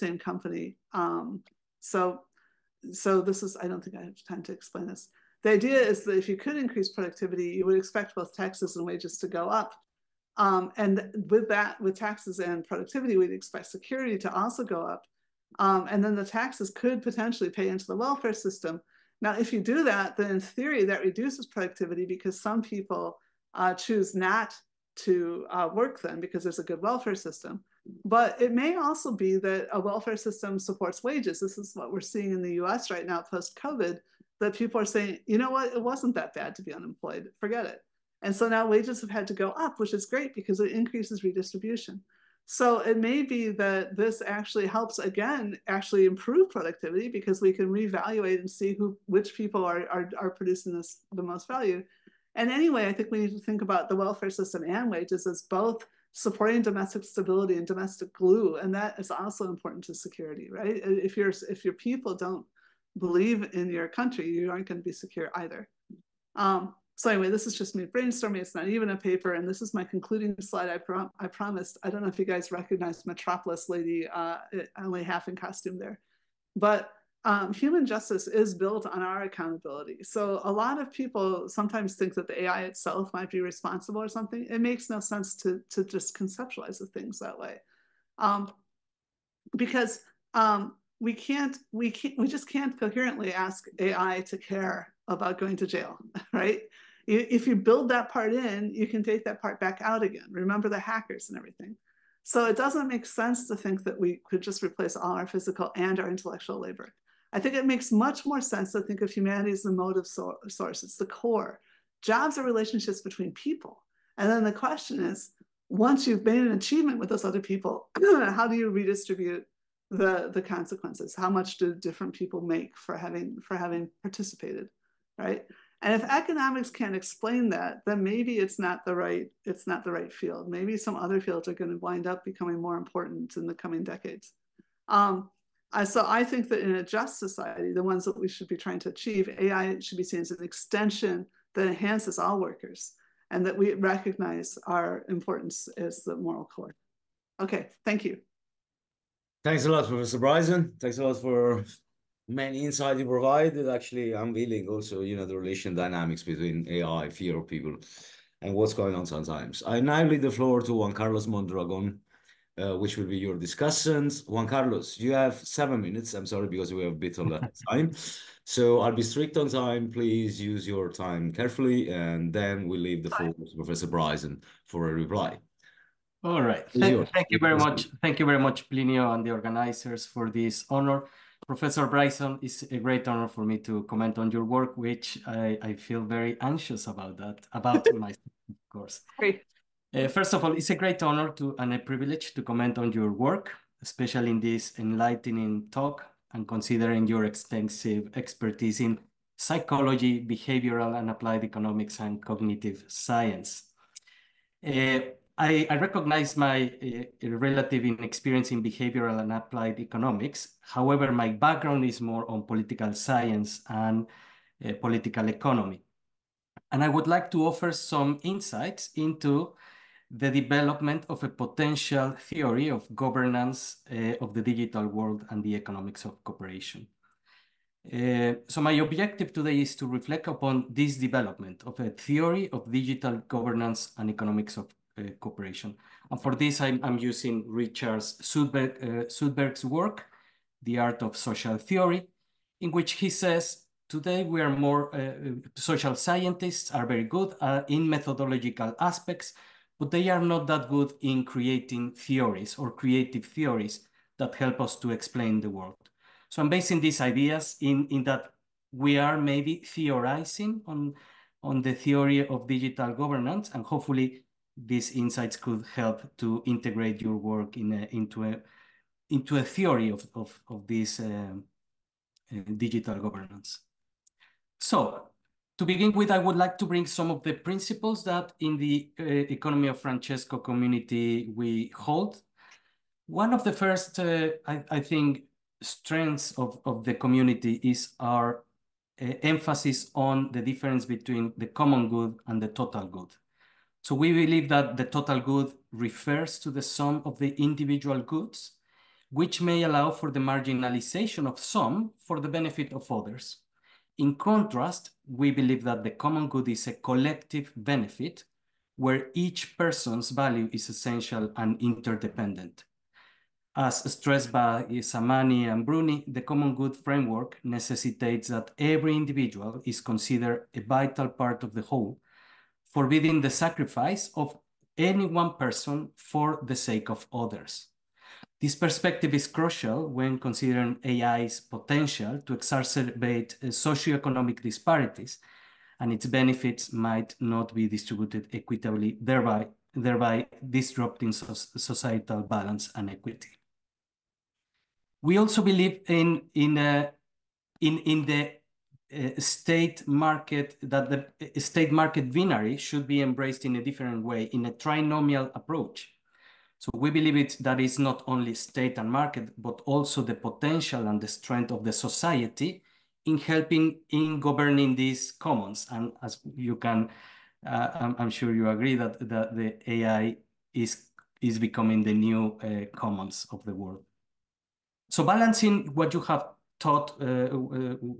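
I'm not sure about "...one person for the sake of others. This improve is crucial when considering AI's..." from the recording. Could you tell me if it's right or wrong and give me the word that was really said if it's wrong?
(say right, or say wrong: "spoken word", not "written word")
wrong: "perspective", not "improve".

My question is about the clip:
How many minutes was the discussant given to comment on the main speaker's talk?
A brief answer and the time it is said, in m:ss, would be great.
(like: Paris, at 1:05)
7, at 2:45.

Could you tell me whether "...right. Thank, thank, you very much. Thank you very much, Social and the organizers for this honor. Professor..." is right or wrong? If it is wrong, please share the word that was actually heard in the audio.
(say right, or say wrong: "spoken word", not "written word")
wrong: "Plinio", not "Social".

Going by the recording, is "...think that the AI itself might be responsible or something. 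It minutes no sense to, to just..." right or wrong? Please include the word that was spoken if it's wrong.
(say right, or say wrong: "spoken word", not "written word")
wrong: "makes", not "minutes".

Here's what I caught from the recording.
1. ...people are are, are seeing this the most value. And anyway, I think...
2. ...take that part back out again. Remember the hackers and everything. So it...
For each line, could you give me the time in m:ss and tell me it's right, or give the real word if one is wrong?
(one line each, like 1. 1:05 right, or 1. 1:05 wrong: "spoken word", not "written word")
1. 0:49 wrong: "producing", not "seeing"
2. 1:39 right.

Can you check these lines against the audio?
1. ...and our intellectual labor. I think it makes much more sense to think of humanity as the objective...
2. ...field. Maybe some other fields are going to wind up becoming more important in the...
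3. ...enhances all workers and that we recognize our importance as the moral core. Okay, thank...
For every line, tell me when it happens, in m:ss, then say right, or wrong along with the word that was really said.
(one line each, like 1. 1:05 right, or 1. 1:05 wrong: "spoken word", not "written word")
1. 1:45 wrong: "motive", not "objective"
2. 2:10 right
3. 2:21 right.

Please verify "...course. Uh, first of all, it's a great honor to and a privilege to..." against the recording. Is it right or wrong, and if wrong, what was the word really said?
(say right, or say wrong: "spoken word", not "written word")
right.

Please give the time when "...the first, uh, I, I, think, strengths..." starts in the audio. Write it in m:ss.
4:43.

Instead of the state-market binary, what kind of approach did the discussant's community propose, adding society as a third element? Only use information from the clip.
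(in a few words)
trinomial approach.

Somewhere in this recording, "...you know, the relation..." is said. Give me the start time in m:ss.
2:35.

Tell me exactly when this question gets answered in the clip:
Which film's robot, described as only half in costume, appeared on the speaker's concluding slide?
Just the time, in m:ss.
1:13.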